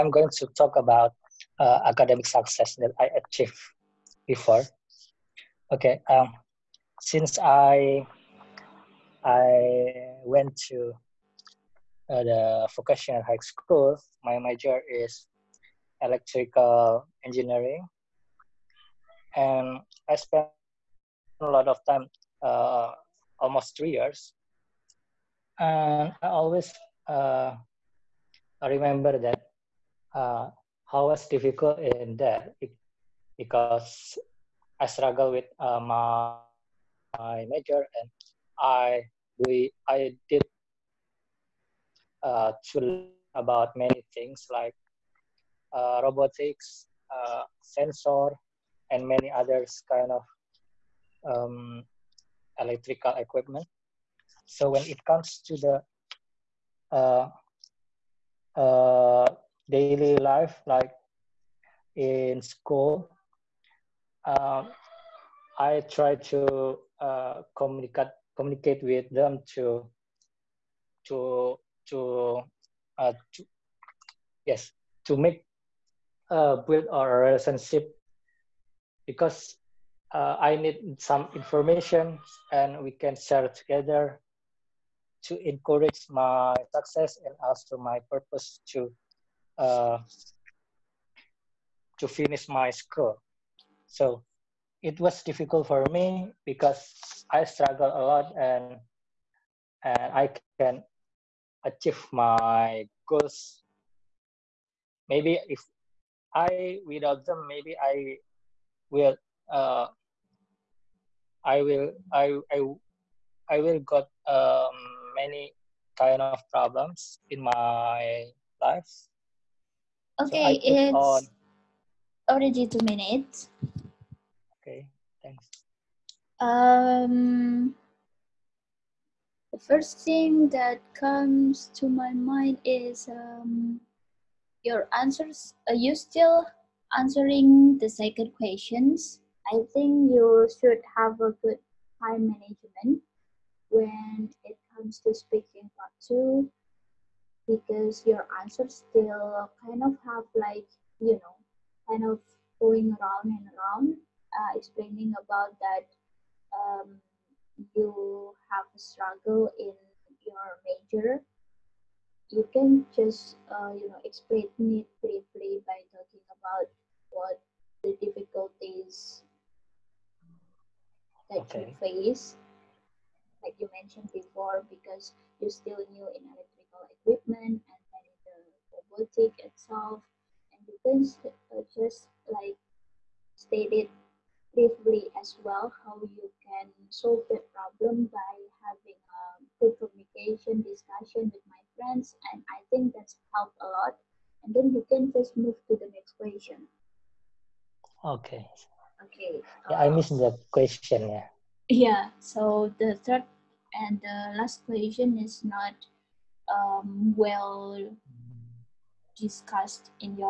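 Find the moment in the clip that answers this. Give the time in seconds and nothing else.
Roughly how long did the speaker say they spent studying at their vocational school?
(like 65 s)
23 s.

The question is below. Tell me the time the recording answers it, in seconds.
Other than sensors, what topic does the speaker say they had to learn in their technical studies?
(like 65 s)
46 s.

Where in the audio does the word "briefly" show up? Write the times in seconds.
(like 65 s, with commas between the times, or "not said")
164 s, 184 s.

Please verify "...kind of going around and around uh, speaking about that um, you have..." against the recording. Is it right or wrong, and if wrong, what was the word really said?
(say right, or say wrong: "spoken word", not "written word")
wrong: "explaining", not "speaking".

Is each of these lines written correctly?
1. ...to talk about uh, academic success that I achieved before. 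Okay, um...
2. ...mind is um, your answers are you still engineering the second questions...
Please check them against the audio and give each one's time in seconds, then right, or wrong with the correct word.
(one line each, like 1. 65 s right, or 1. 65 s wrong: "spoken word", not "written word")
1. 0 s right
2. 132 s wrong: "answering", not "engineering".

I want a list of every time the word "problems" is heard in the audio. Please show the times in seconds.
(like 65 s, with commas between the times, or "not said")
116 s, 187 s.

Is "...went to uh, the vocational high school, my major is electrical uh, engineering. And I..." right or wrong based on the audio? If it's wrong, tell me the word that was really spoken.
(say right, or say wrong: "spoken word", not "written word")
right.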